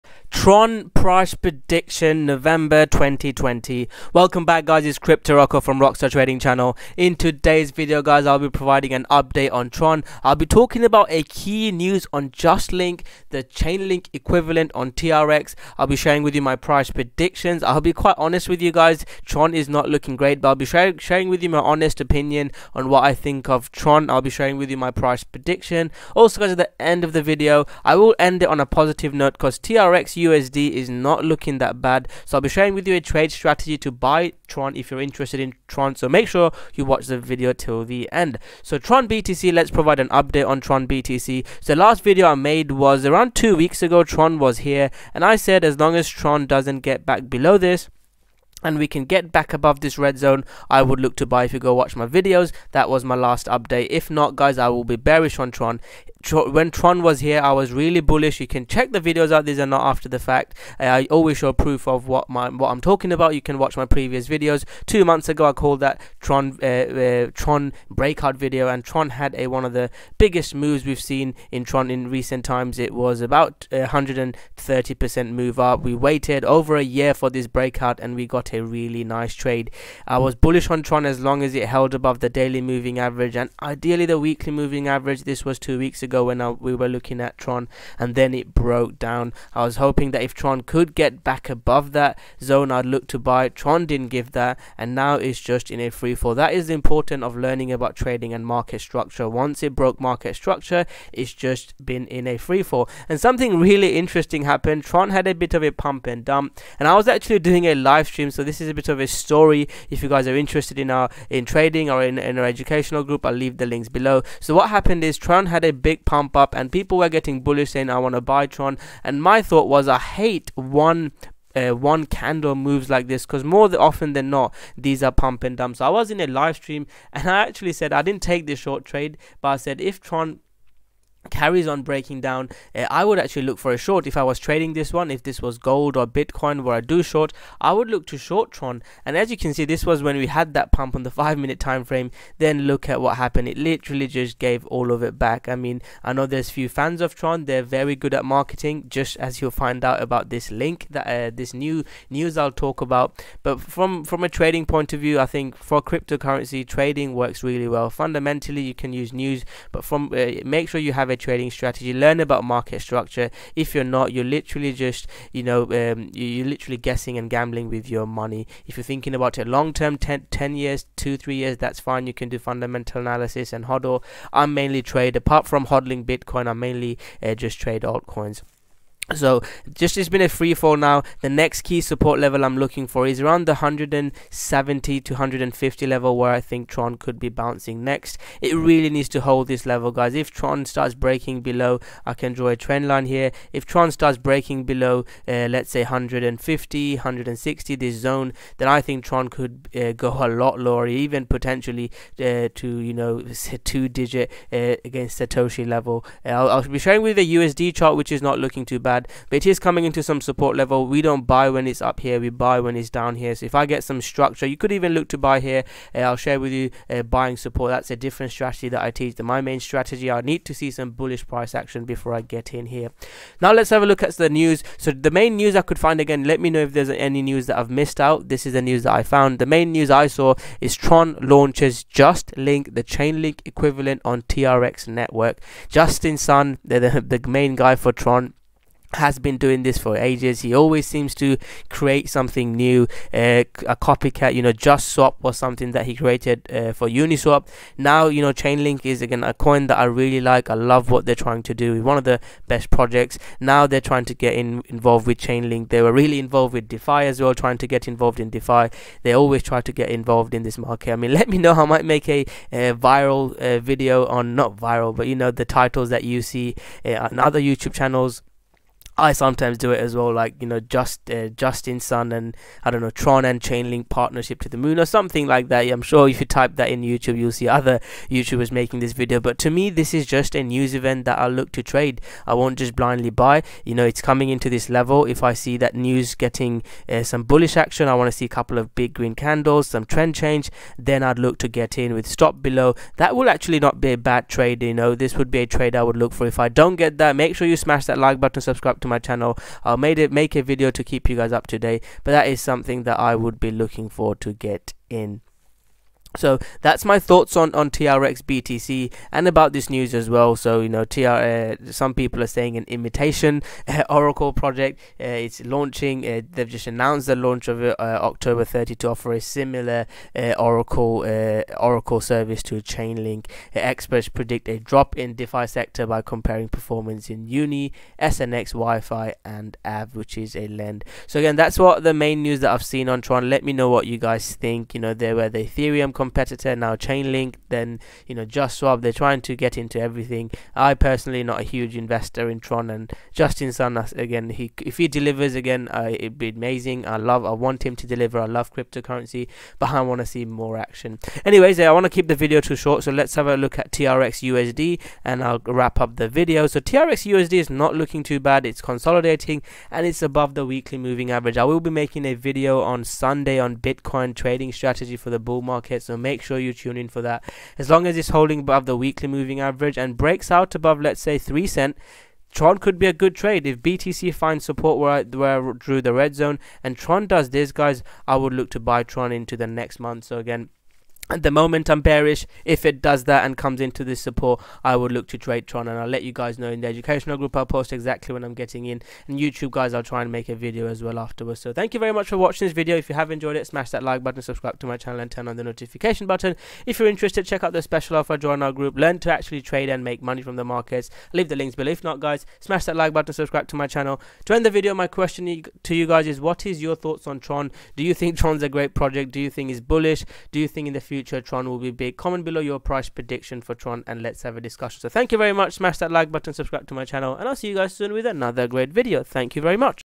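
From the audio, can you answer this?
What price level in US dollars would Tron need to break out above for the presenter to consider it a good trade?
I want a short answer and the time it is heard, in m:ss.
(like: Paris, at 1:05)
3 cents, at 6:11.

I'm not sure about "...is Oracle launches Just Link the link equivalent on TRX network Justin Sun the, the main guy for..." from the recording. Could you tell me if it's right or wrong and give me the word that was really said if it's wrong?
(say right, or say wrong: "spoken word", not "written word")
wrong: "Tron", not "Oracle".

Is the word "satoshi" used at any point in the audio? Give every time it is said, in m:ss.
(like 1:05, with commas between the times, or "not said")
3:25.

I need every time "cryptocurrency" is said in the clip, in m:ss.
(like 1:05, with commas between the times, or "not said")
2:35, 5:48.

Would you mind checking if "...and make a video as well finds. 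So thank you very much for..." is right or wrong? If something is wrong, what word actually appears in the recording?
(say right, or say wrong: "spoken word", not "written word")
wrong: "afterwards", not "finds".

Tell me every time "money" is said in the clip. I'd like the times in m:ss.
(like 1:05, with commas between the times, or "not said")
2:48, 6:40.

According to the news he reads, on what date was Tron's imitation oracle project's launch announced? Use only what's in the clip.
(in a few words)
October 30.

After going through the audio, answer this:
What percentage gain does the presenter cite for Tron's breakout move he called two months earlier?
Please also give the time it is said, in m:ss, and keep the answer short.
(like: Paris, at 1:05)
130%, at 1:13.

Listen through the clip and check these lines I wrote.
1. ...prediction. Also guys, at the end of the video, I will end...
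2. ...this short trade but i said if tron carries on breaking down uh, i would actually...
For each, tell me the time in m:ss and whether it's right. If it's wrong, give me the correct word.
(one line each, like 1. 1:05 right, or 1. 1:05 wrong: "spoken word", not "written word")
1. 0:25 right
2. 2:08 right.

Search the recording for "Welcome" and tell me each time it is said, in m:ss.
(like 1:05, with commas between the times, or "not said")
0:04.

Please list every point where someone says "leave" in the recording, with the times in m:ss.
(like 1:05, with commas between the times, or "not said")
1:53, 6:41.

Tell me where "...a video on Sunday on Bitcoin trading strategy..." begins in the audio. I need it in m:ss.
6:02.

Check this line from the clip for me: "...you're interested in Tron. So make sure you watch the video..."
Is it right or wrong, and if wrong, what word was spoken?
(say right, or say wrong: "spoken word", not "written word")
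right.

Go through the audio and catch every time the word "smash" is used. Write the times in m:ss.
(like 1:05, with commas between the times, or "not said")
4:57, 6:33, 6:42, 6:55.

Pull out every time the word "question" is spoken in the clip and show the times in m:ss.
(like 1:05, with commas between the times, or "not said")
6:44.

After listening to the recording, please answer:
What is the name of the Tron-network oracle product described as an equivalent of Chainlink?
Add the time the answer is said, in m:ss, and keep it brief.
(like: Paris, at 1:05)
Justlink, at 0:12.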